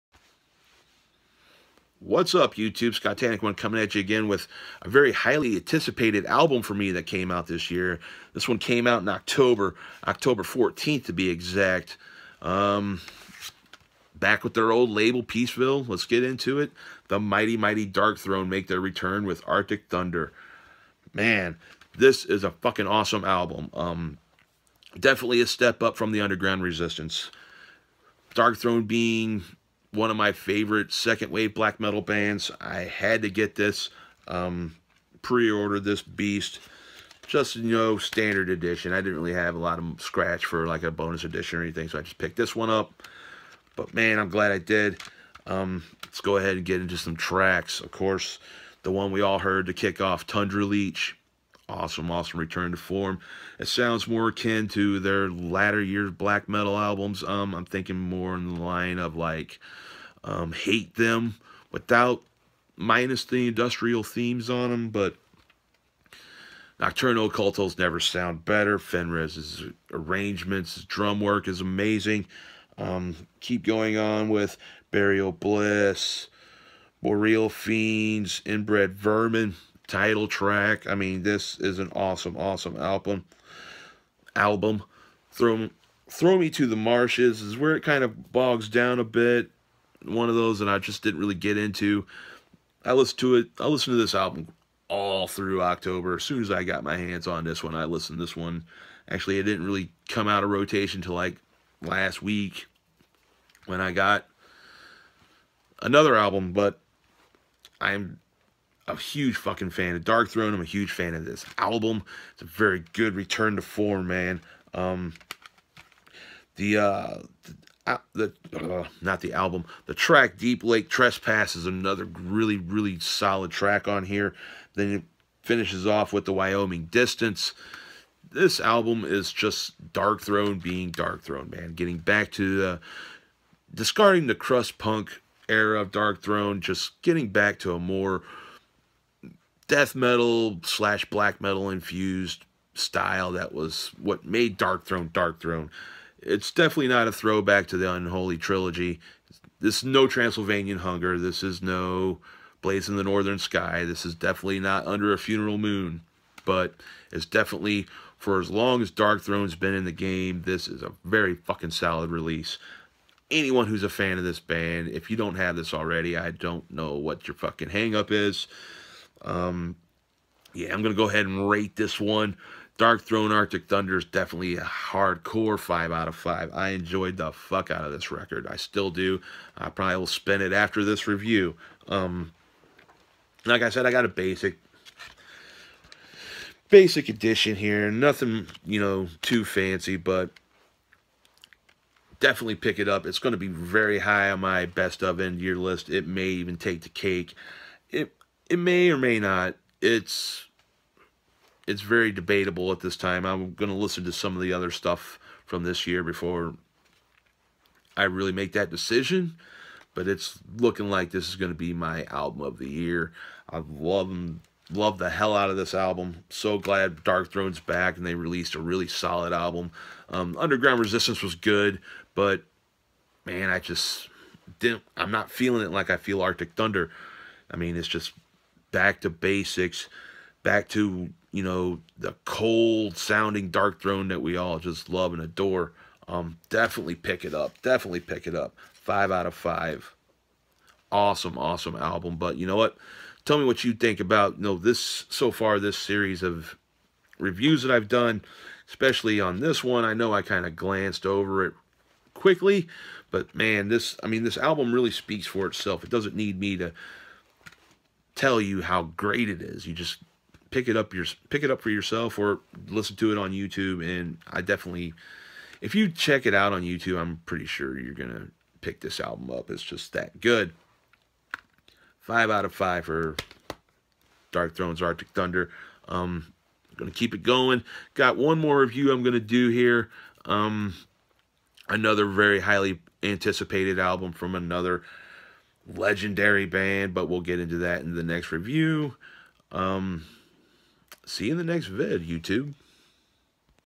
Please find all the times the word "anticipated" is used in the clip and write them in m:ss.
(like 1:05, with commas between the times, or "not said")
0:05, 4:43.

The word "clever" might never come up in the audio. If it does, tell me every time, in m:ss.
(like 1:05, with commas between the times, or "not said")
not said.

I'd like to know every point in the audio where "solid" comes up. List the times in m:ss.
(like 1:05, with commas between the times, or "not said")
2:02, 2:41, 3:38.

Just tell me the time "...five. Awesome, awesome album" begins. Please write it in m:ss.
3:59.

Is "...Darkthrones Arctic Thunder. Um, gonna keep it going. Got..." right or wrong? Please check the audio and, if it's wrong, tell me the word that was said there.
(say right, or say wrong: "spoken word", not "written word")
right.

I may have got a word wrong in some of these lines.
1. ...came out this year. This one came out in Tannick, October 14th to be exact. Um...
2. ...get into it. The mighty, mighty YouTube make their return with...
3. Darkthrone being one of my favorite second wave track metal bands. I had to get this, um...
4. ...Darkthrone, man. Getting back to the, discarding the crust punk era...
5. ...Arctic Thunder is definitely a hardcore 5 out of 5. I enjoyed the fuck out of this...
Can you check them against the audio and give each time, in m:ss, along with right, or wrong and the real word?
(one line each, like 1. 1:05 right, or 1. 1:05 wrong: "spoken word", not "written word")
1. 0:07 wrong: "October", not "Tannick"
2. 0:16 wrong: "Darkthrone", not "YouTube"
3. 0:28 wrong: "black", not "track"
4. 2:10 right
5. 2:53 right.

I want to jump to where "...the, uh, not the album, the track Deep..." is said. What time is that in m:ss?
1:58.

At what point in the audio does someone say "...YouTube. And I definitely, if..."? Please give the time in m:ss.
4:23.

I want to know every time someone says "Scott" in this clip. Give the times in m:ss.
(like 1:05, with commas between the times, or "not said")
0:02.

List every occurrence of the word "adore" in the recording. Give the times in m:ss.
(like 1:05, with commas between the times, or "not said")
3:55.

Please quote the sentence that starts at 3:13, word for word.
It's going to be very high on my best of end year list.